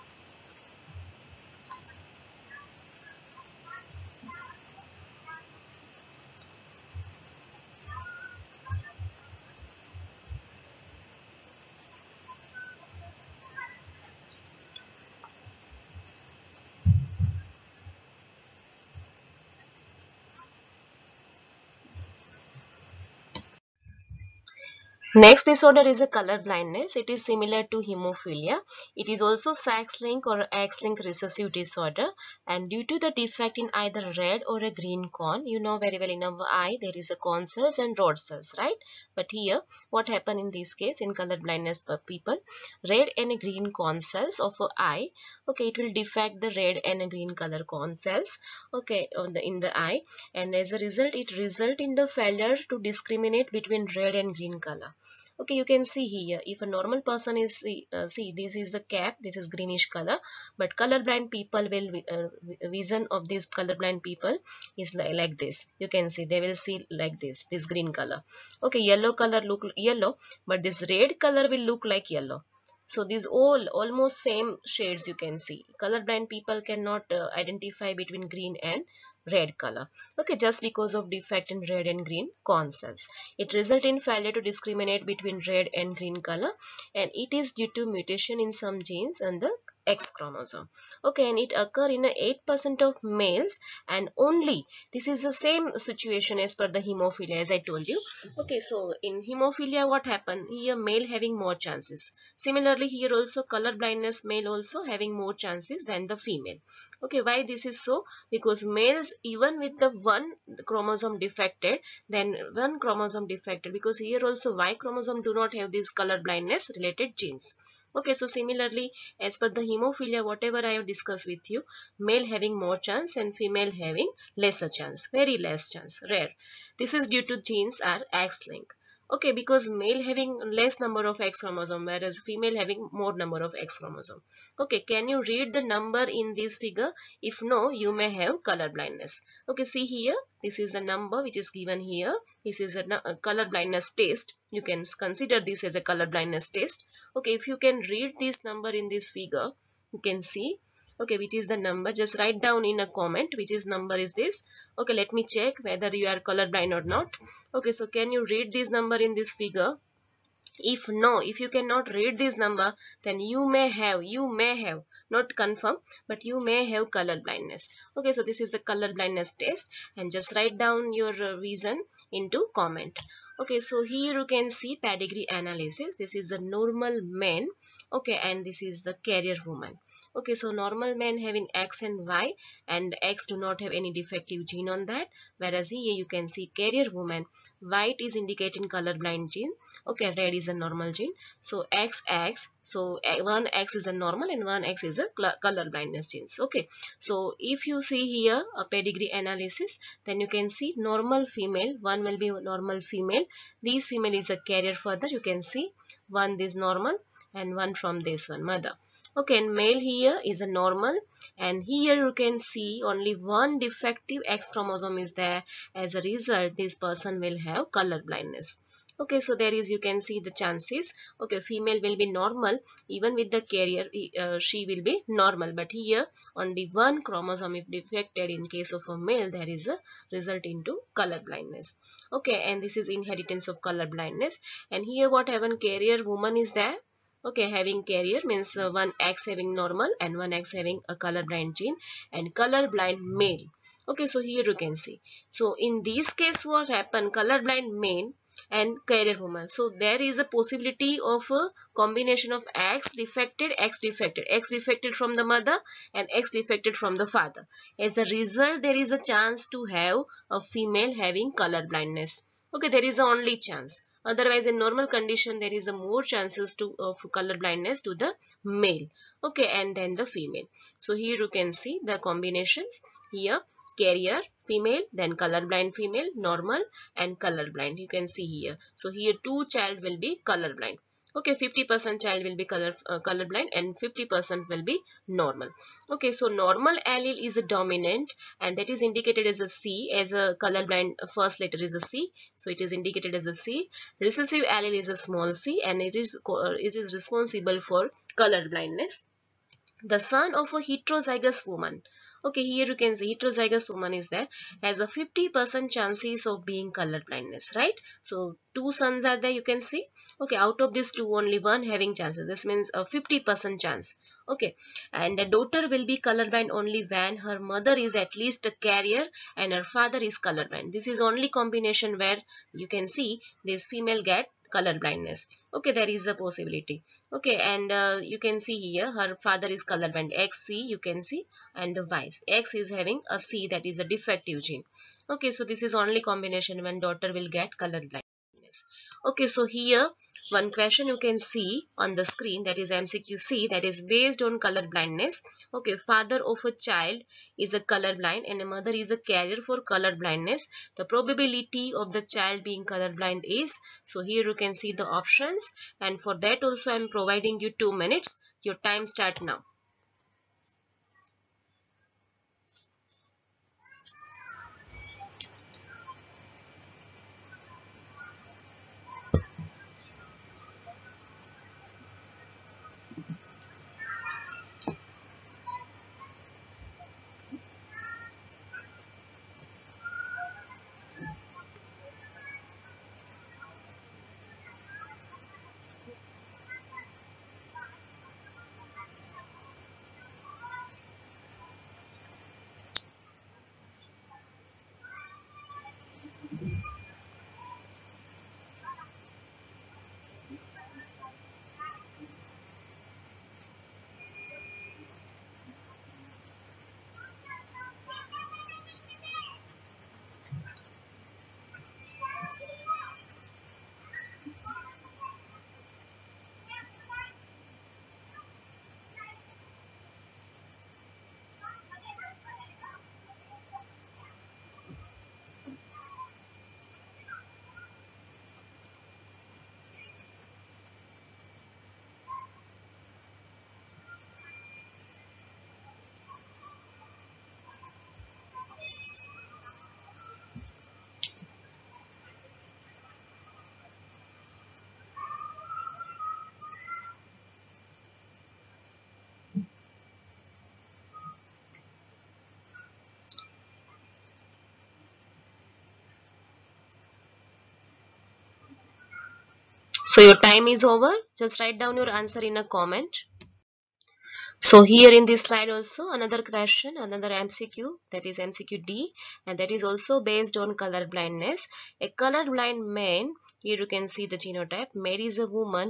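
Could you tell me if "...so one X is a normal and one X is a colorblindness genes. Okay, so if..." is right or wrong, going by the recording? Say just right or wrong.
right.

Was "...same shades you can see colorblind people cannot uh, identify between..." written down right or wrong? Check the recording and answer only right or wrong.
right.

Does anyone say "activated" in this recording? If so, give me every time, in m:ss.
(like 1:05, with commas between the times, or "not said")
not said.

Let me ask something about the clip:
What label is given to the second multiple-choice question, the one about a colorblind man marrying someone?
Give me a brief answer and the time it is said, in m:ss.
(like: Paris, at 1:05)
MCQ D, at 7:48.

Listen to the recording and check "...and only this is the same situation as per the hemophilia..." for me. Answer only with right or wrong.
right.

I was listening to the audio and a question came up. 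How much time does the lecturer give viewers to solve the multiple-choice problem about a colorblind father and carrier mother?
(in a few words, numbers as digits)
2 minutes.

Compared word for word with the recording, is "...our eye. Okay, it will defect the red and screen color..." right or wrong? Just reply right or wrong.
wrong.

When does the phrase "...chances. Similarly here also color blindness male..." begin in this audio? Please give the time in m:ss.
1:41.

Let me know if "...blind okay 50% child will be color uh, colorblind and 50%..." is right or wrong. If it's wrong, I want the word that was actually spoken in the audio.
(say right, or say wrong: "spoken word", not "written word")
right.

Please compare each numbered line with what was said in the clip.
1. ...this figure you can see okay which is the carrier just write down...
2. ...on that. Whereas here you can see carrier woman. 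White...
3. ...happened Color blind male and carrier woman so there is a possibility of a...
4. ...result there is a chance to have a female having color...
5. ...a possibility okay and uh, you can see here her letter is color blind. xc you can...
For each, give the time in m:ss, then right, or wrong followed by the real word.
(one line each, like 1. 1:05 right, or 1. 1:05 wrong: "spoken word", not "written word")
1. 2:28 wrong: "number", not "carrier"
2. 3:04 right
3. 4:06 right
4. 4:18 right
5. 5:26 wrong: "father", not "letter".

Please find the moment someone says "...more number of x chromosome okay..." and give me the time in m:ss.
2:12.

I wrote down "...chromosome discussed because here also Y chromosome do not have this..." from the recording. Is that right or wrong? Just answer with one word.
wrong.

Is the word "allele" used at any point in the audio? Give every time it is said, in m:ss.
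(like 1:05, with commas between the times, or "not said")
4:46, 4:54.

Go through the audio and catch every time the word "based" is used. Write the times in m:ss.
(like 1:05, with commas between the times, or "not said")
5:43, 7:50.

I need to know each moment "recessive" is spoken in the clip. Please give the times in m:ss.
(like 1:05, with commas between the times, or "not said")
0:31, 4:54.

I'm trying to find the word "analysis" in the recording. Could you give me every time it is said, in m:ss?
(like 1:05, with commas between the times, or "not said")
2:55, 3:19.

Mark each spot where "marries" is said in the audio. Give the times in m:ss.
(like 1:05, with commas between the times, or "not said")
7:54.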